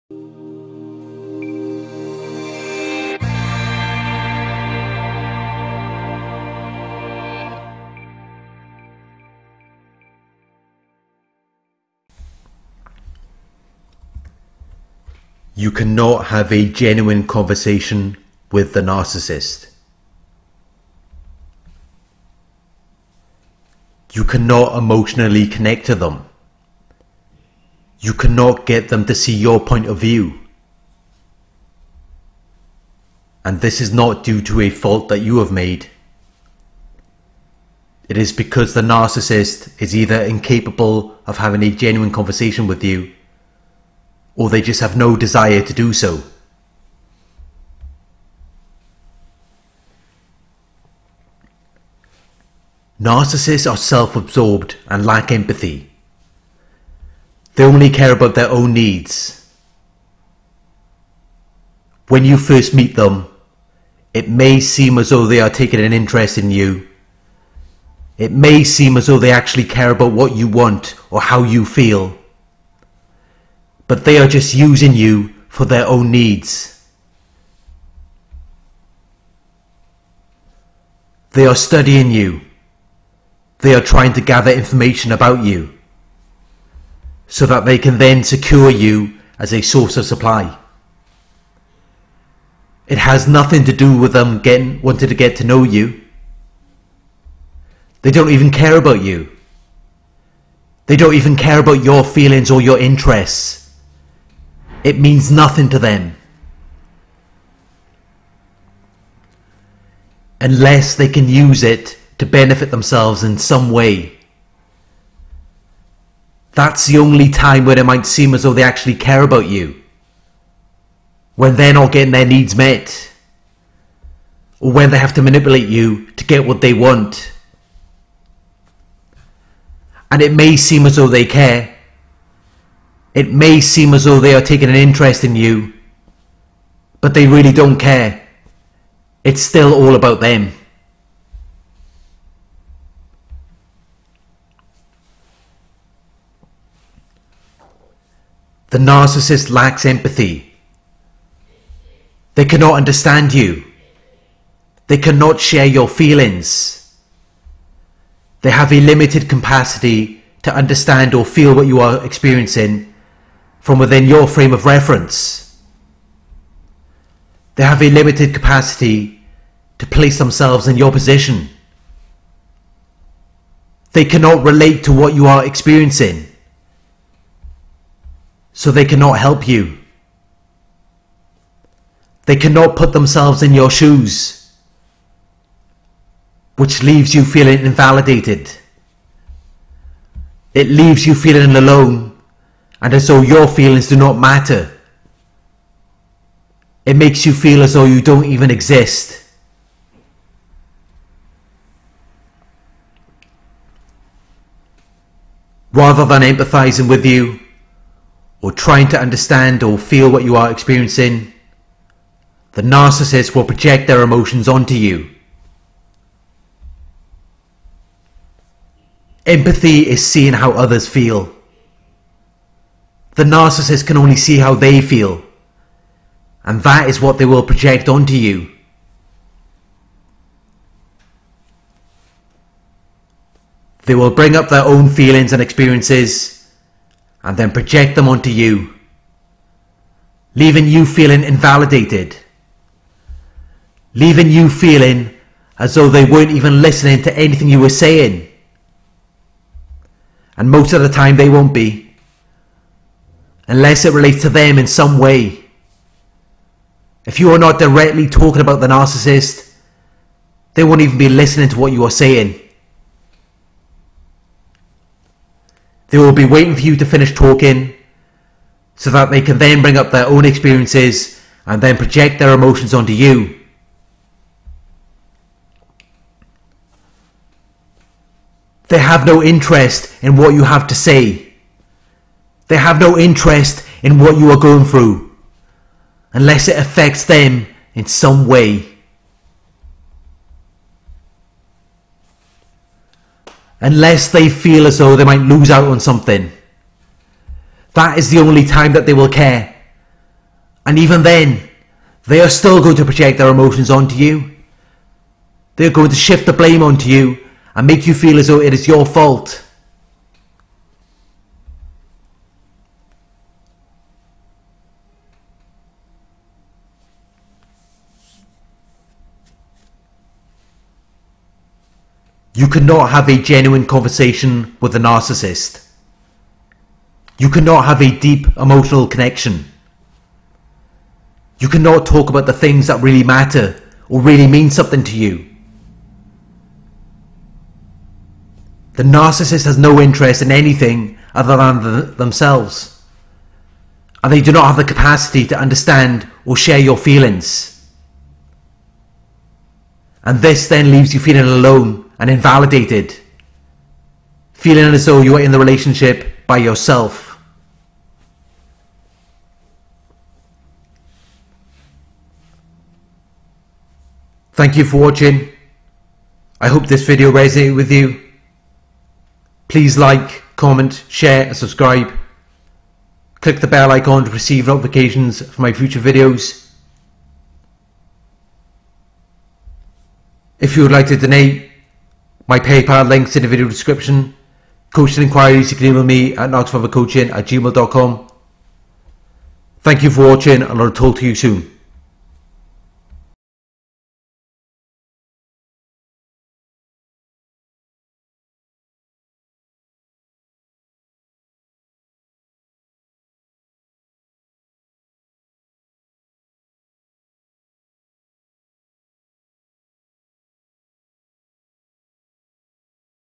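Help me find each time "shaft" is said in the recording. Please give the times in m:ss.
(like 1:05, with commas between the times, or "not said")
not said.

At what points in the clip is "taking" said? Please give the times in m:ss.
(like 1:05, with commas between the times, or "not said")
1:05, 2:14.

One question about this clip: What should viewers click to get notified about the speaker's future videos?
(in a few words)
bell icon.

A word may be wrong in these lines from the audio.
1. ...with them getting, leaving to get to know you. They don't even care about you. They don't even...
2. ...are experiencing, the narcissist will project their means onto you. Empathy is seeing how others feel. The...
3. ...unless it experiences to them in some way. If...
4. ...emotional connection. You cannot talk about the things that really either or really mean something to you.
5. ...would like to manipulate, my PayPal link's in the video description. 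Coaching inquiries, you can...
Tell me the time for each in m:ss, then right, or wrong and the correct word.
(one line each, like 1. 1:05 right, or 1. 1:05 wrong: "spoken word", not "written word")
1. 1:33 wrong: "wanting", not "leaving"
2. 3:30 wrong: "emotions", not "means"
3. 4:13 wrong: "relates", not "experiences"
4. 5:28 wrong: "matter", not "either"
5. 6:20 wrong: "donate", not "manipulate".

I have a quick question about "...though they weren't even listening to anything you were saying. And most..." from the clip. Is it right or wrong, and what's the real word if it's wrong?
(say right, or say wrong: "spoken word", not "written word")
right.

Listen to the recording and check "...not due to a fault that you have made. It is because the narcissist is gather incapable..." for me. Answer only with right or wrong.
wrong.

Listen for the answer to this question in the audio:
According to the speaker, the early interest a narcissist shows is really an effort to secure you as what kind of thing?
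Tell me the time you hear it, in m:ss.
1:29.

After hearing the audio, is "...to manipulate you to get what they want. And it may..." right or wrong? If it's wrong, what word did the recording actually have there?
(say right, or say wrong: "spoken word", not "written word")
right.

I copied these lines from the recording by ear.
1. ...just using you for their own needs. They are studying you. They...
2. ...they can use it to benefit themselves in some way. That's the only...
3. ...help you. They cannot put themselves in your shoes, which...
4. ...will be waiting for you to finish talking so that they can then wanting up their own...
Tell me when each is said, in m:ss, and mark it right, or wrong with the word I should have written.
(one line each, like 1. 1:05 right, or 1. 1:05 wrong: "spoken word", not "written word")
1. 1:14 right
2. 1:50 right
3. 2:59 right
4. 4:25 wrong: "bring", not "wanting".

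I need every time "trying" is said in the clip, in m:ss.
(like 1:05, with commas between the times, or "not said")
1:23, 3:28.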